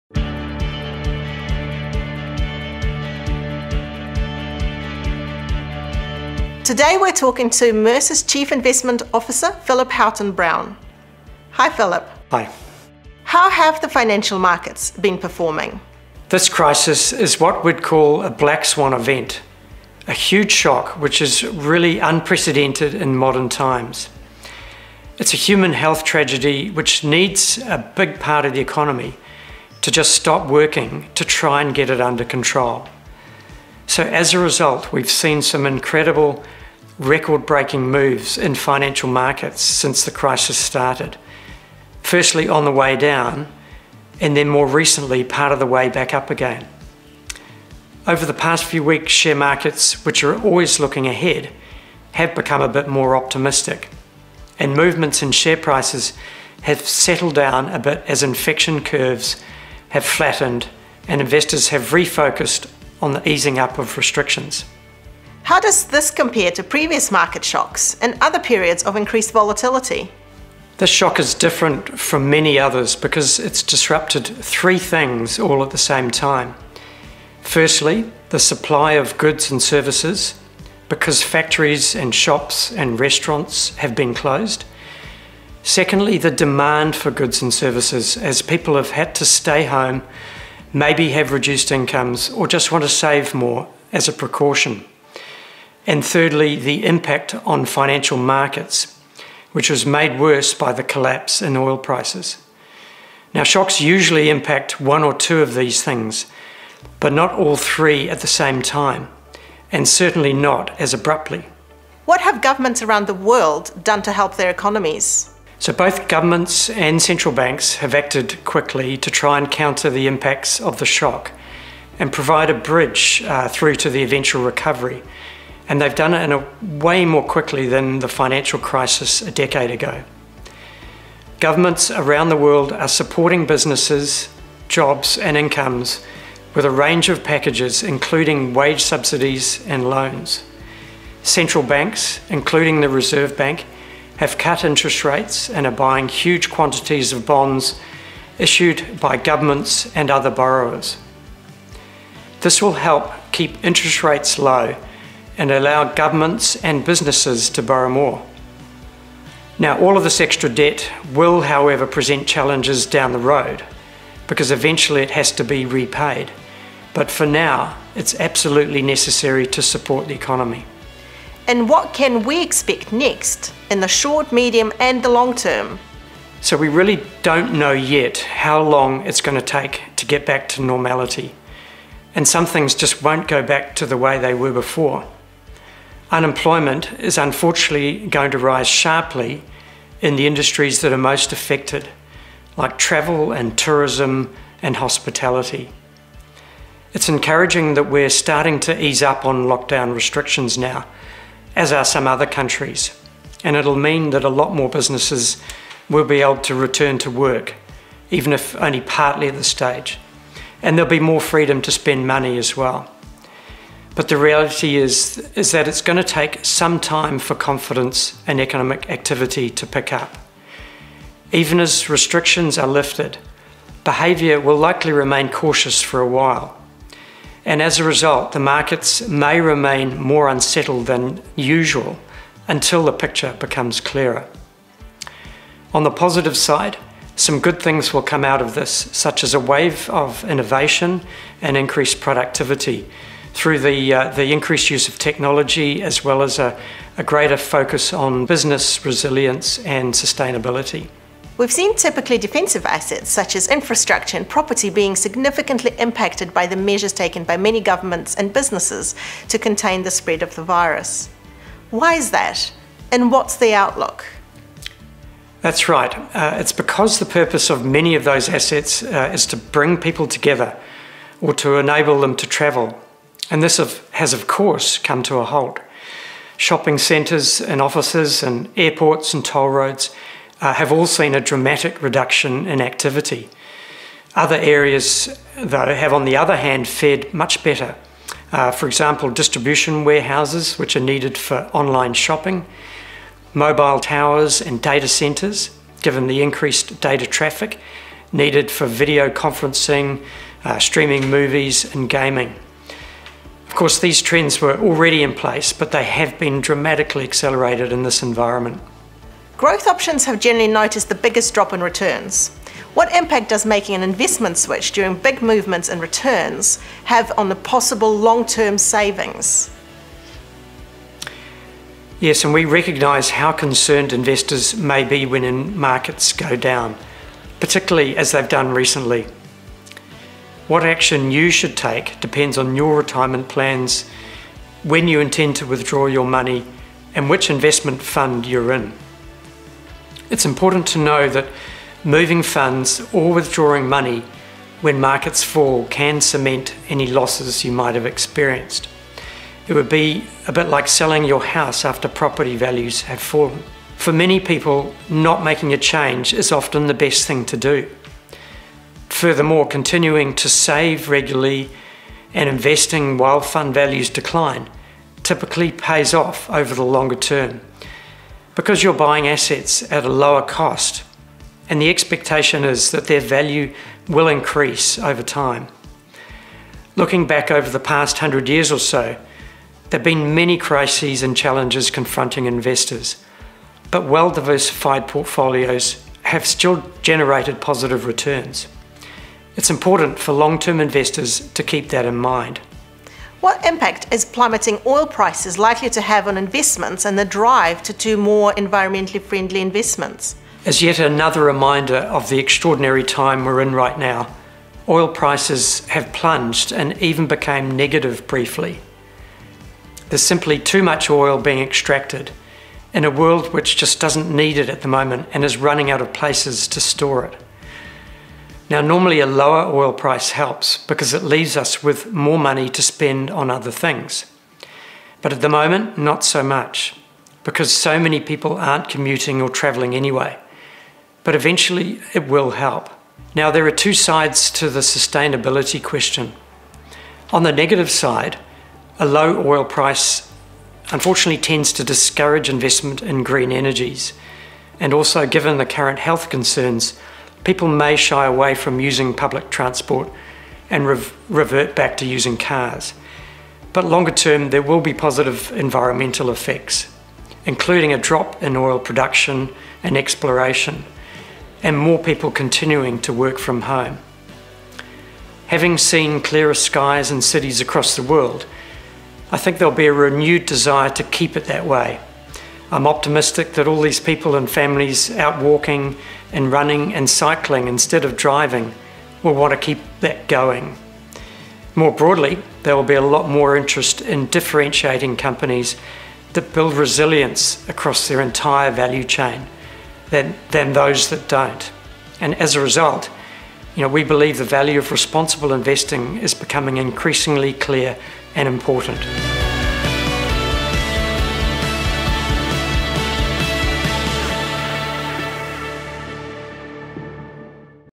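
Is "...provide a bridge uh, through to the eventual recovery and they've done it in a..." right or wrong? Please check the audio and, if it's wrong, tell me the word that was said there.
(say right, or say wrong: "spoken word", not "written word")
right.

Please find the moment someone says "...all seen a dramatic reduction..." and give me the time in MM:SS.
04:40.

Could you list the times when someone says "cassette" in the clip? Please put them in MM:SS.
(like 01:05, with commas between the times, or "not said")
not said.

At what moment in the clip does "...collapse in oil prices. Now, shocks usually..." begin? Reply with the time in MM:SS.
01:40.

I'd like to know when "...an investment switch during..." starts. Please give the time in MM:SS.
05:13.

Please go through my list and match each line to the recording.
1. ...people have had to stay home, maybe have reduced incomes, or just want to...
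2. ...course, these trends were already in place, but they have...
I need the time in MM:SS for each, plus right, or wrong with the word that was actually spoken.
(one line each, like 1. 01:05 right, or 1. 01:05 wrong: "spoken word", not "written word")
1. 01:28 right
2. 05:03 right.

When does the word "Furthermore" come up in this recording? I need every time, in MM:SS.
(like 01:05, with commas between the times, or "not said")
05:59.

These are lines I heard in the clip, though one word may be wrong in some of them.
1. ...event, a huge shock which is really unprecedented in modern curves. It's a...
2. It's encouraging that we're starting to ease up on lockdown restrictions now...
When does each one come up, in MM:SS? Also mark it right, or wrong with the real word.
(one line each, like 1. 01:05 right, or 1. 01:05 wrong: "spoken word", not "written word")
1. 00:18 wrong: "times", not "curves"
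2. 03:16 right.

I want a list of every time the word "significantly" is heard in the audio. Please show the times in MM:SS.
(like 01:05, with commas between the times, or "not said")
04:14.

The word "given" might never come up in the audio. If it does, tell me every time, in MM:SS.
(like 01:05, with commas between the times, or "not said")
04:55, 07:25.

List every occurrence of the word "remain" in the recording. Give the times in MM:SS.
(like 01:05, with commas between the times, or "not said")
03:44, 03:49.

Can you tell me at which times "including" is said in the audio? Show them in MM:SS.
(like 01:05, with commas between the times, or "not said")
02:17, 02:22, 07:37.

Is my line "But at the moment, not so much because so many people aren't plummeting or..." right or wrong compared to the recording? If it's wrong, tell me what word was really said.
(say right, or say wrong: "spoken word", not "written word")
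wrong: "commuting", not "plummeting".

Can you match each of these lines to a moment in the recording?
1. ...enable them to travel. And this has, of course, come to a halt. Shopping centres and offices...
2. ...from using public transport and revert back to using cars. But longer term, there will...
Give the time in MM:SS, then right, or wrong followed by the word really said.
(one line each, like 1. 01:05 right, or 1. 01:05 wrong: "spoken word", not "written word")
1. 04:31 right
2. 07:28 right.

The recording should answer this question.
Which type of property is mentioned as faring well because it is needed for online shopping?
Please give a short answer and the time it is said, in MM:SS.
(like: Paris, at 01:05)
distribution warehouses, at 04:49.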